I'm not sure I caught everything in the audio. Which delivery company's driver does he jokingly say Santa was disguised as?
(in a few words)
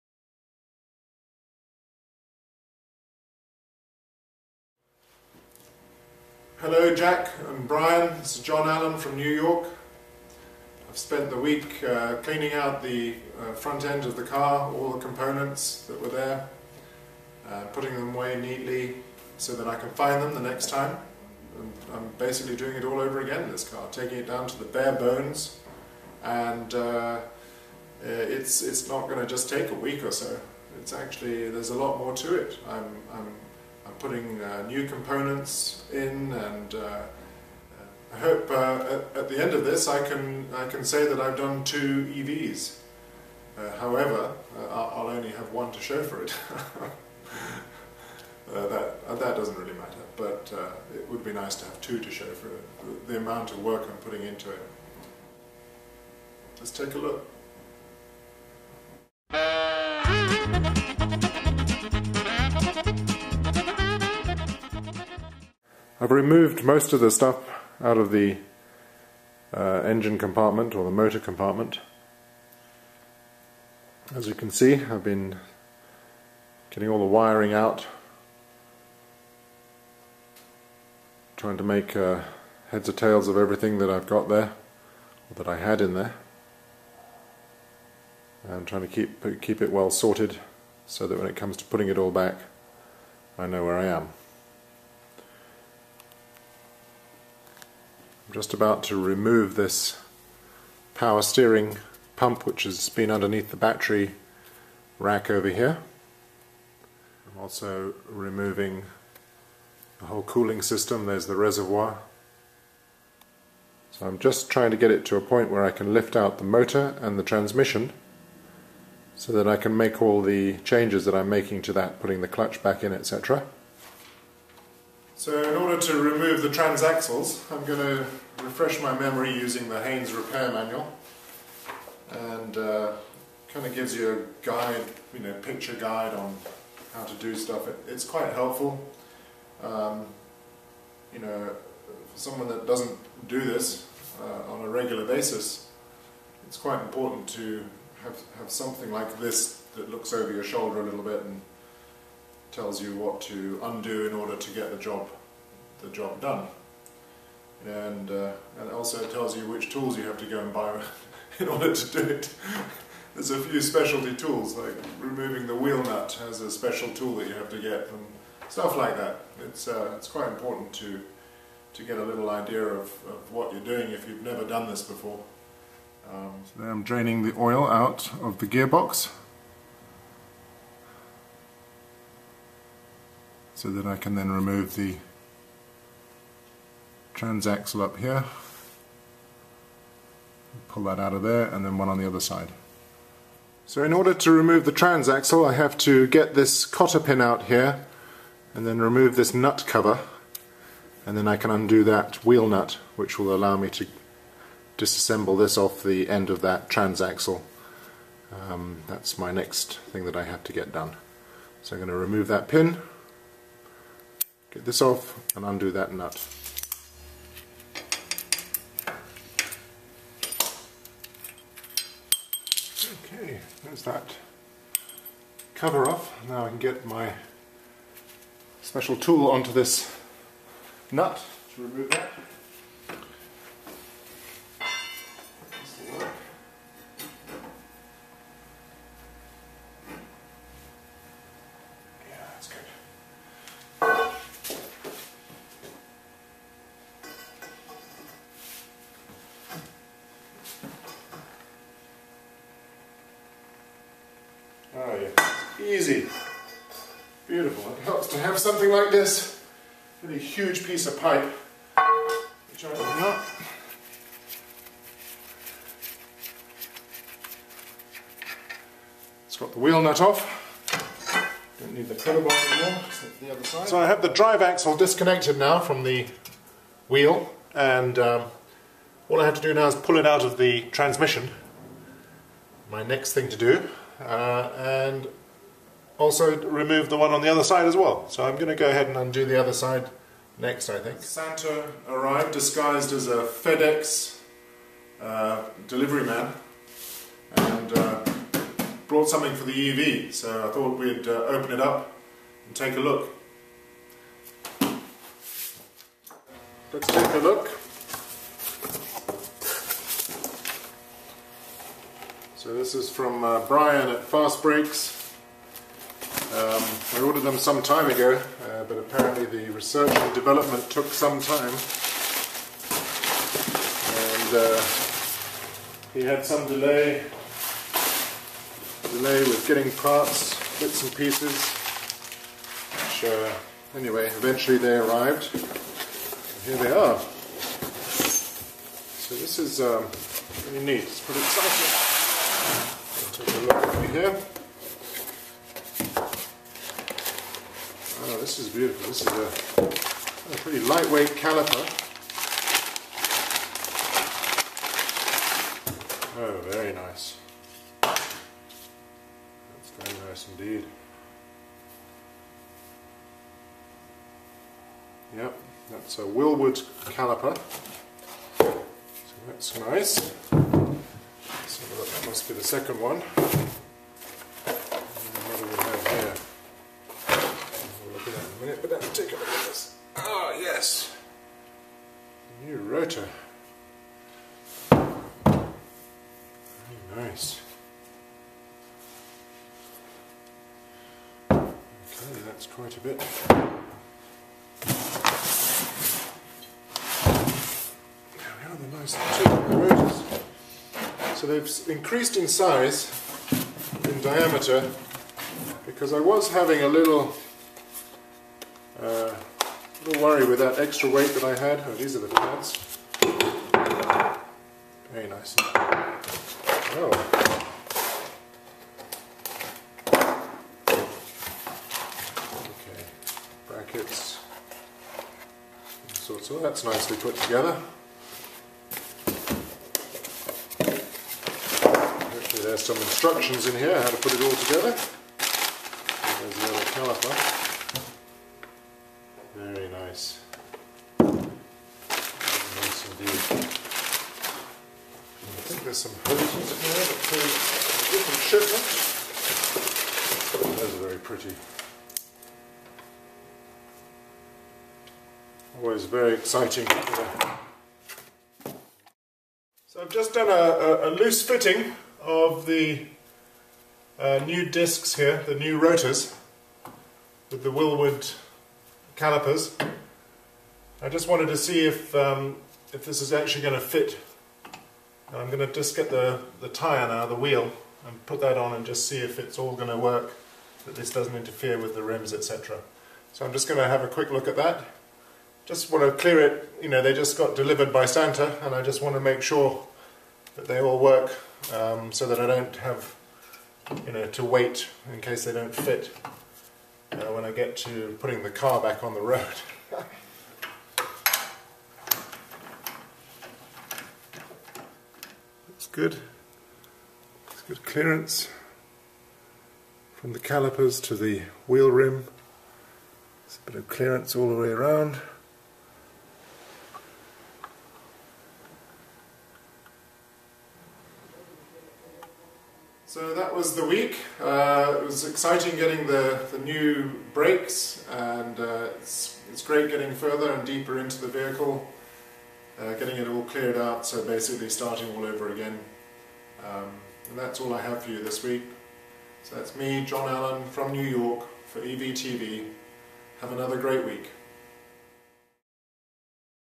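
FedEx.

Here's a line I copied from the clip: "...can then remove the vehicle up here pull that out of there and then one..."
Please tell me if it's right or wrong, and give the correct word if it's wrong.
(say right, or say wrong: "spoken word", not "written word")
wrong: "transaxle", not "vehicle".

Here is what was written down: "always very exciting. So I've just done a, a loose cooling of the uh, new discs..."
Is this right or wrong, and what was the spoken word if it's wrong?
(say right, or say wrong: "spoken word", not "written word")
wrong: "fitting", not "cooling".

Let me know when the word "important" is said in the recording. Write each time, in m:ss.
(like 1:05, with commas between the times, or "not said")
2:26, 2:50.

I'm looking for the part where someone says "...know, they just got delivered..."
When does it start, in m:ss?
8:06.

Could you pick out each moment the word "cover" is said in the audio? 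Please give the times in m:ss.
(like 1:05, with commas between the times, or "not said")
3:19, 3:45.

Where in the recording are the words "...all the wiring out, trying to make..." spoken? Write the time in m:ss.
1:16.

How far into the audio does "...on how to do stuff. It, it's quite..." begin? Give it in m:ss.
2:16.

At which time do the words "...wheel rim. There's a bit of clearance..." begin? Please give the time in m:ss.
8:31.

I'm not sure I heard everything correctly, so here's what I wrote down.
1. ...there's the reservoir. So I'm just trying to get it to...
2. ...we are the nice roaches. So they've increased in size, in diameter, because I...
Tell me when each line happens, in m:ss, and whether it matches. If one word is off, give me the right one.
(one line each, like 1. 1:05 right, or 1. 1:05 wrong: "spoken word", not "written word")
1. 1:51 right
2. 6:38 right.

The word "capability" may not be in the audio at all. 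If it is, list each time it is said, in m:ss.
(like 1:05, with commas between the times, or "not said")
not said.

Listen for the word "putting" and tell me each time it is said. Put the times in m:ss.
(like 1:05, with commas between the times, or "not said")
0:17, 0:33, 0:53, 1:31, 2:01, 8:17.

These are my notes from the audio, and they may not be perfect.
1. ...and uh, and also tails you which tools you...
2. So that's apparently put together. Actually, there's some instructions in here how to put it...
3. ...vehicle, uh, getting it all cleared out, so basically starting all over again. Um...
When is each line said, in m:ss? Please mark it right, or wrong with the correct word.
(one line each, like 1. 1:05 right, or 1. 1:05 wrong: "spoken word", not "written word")
1. 2:37 wrong: "tells", not "tails"
2. 7:06 wrong: "nicely", not "apparently"
3. 8:51 right.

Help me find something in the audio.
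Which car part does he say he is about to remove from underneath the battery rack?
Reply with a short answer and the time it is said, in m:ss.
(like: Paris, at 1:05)
power steering pump, at 1:40.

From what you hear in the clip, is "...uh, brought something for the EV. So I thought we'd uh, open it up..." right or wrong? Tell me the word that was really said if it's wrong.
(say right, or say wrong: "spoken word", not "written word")
right.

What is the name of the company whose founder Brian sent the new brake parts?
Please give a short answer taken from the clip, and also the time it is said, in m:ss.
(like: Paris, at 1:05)
Fast Brakes, at 5:14.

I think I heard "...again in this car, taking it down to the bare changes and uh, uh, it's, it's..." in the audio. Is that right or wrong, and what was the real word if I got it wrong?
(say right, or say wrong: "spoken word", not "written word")
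wrong: "bones", not "changes".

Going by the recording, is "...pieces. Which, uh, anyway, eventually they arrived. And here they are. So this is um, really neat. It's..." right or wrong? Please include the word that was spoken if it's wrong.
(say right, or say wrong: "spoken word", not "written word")
right.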